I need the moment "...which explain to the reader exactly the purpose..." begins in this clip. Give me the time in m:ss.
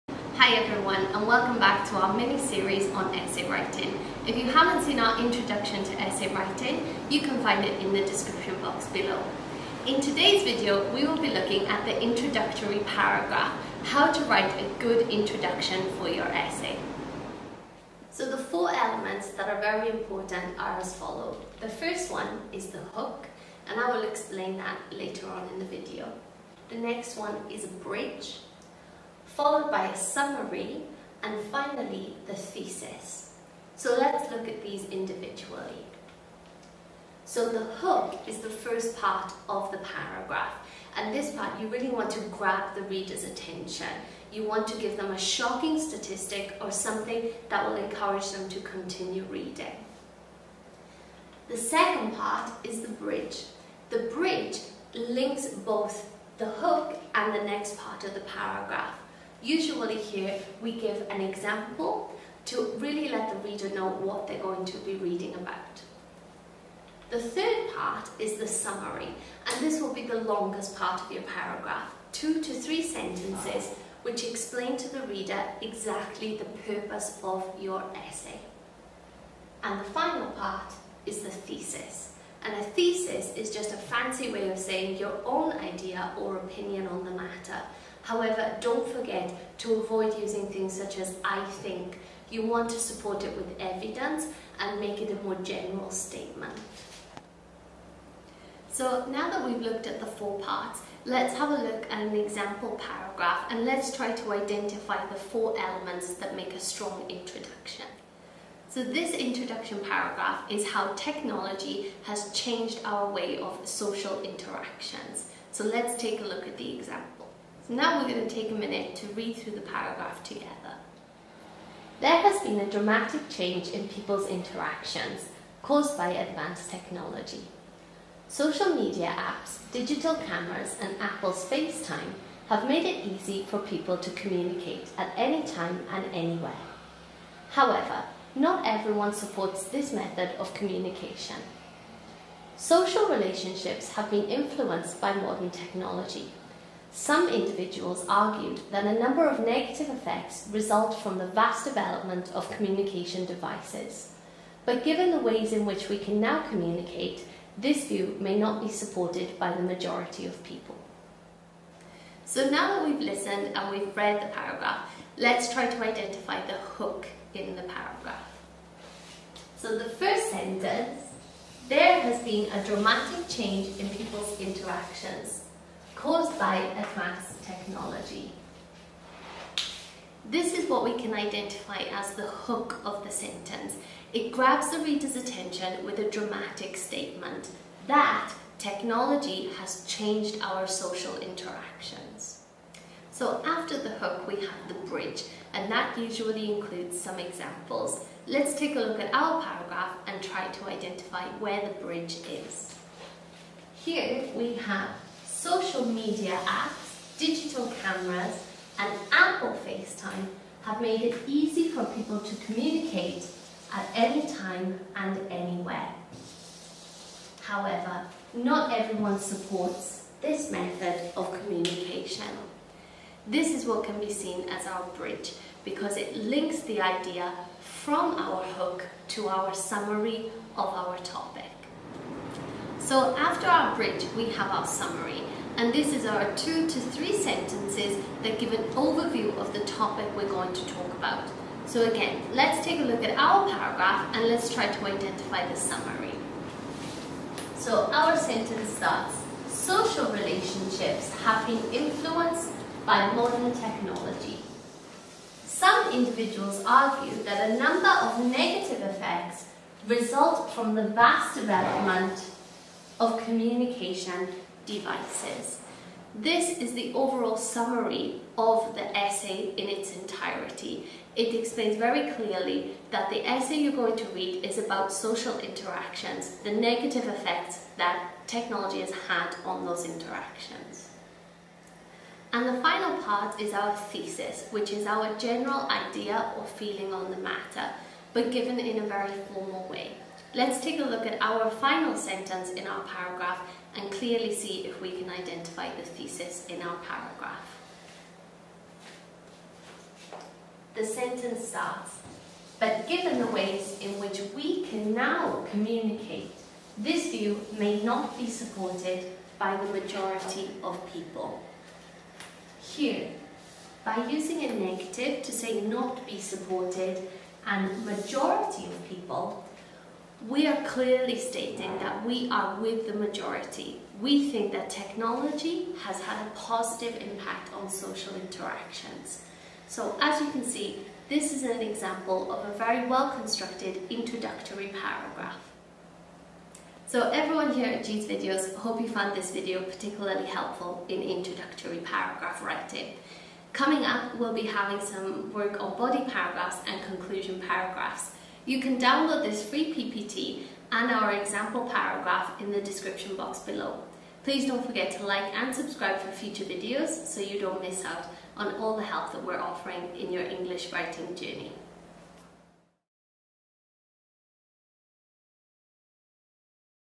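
1:14.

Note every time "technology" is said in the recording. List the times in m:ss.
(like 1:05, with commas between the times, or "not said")
1:50, 2:06, 2:25, 2:57, 3:08, 4:13, 4:38, 5:24.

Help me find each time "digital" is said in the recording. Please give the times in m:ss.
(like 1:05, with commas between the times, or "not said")
2:09, 3:27.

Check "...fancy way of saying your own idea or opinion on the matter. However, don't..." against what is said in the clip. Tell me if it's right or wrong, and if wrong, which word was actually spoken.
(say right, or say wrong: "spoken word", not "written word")
right.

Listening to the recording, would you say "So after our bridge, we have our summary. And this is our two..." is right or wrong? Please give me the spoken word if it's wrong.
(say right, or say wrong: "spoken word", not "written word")
right.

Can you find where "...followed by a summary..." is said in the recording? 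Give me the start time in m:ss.
0:29.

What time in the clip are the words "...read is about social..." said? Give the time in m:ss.
4:34.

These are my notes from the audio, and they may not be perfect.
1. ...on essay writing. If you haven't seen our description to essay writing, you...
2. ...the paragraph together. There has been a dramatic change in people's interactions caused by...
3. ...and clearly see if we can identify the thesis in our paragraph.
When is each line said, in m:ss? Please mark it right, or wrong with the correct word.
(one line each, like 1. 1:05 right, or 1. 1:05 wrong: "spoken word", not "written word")
1. 0:02 wrong: "introduction", not "description"
2. 1:59 right
3. 4:53 right.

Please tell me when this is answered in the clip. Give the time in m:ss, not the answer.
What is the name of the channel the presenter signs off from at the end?
5:37.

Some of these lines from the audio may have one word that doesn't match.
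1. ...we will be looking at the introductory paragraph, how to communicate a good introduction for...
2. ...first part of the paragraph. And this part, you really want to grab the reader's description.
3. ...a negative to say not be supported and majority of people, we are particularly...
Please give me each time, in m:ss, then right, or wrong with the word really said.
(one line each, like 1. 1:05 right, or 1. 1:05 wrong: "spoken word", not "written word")
1. 0:10 wrong: "write", not "communicate"
2. 0:38 wrong: "attention", not "description"
3. 5:14 wrong: "clearly", not "particularly".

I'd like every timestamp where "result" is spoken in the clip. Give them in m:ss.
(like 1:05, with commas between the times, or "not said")
2:30, 4:19.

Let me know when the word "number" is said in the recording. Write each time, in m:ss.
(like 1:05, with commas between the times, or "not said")
2:29, 4:17.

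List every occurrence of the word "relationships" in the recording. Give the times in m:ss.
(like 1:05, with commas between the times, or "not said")
2:23, 4:10.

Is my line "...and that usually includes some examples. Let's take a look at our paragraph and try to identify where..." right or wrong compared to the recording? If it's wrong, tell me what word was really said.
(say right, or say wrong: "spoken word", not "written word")
right.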